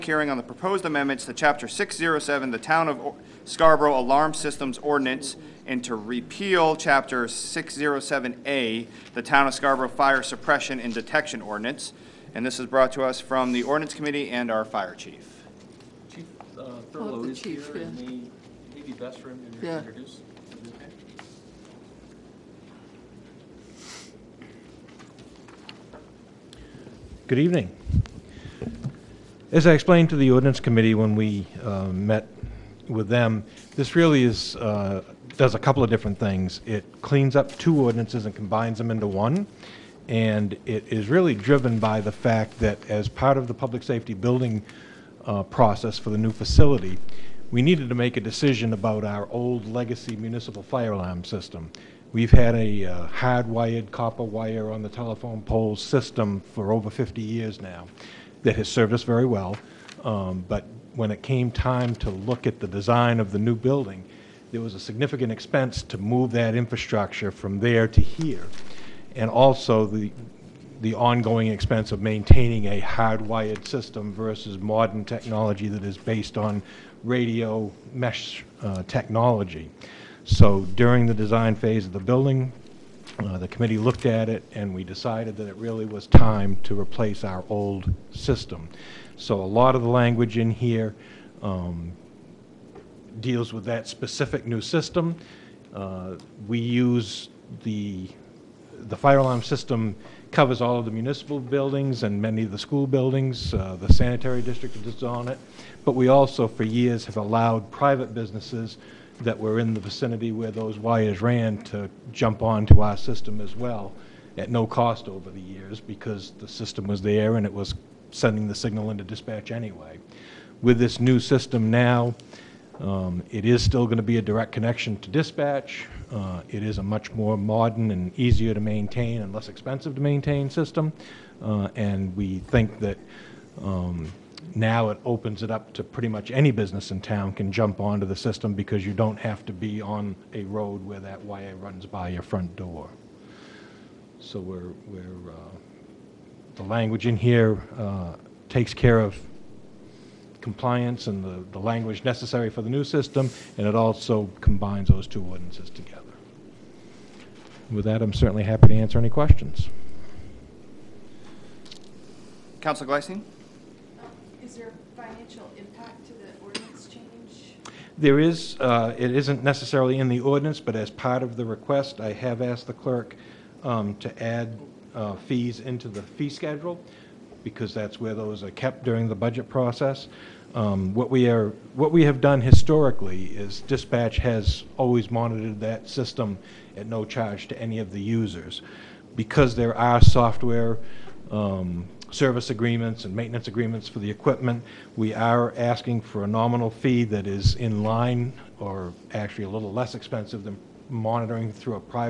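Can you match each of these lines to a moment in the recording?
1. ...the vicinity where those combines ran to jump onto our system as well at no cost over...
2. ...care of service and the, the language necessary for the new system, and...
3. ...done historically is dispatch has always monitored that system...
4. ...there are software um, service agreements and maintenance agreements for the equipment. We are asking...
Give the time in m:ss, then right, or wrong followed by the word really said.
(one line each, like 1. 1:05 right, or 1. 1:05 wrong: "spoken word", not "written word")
1. 1:49 wrong: "wires", not "combines"
2. 2:28 wrong: "compliance", not "service"
3. 3:02 right
4. 3:09 right.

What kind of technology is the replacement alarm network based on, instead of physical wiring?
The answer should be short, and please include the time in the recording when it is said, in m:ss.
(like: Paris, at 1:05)
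radio mesh, at 1:17.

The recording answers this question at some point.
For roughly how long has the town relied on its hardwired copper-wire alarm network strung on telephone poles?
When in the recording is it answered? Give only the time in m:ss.
0:56.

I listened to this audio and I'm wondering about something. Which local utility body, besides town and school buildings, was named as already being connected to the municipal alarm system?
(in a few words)
the sanitary district.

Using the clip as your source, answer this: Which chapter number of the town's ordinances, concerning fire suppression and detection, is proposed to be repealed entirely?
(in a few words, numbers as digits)
607A.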